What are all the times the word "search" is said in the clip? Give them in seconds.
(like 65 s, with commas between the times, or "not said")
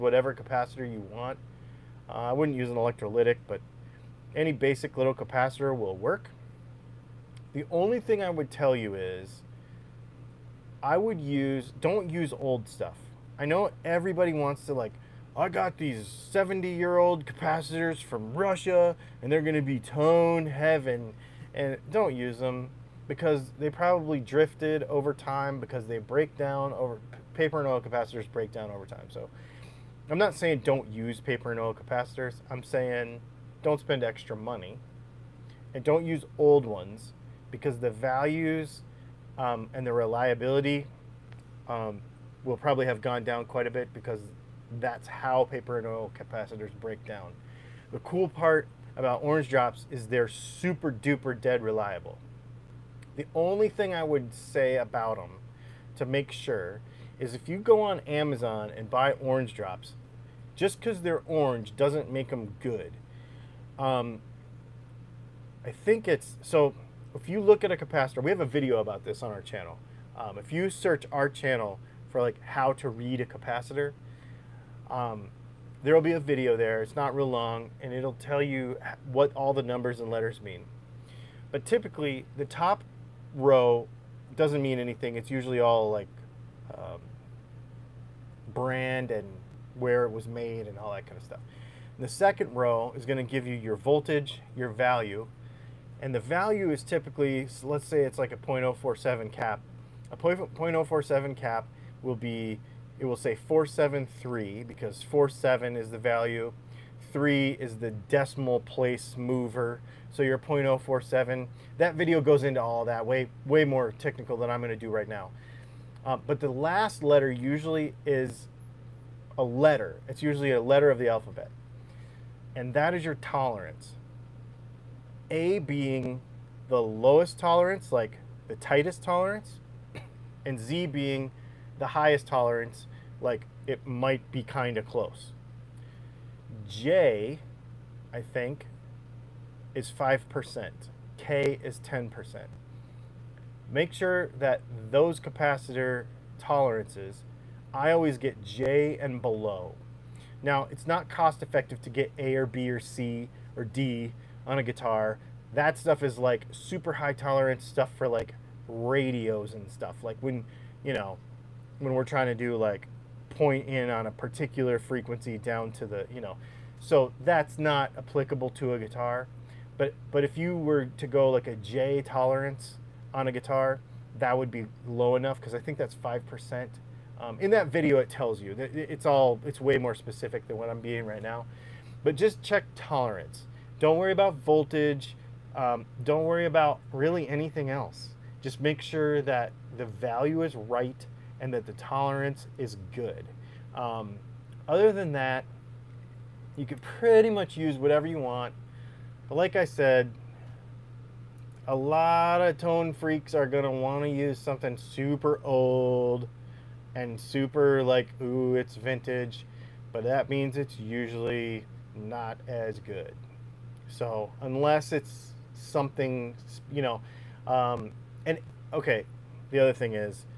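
70 s.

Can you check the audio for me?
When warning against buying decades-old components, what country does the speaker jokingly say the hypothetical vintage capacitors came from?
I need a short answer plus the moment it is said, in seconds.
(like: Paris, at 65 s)
Russia, at 18 s.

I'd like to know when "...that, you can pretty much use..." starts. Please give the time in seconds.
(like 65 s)
195 s.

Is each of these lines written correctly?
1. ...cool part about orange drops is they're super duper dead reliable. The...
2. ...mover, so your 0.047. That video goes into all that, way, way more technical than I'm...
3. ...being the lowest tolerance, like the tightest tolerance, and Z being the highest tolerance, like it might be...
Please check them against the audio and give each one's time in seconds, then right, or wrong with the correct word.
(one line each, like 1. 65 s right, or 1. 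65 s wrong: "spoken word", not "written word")
1. 47 s right
2. 109 s right
3. 125 s right.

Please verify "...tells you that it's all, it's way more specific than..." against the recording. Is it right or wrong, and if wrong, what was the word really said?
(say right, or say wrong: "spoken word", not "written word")
right.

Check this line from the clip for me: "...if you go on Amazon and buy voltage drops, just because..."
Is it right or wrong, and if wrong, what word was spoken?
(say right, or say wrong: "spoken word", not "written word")
wrong: "orange", not "voltage".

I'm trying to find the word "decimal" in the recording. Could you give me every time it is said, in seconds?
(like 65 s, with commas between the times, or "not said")
107 s.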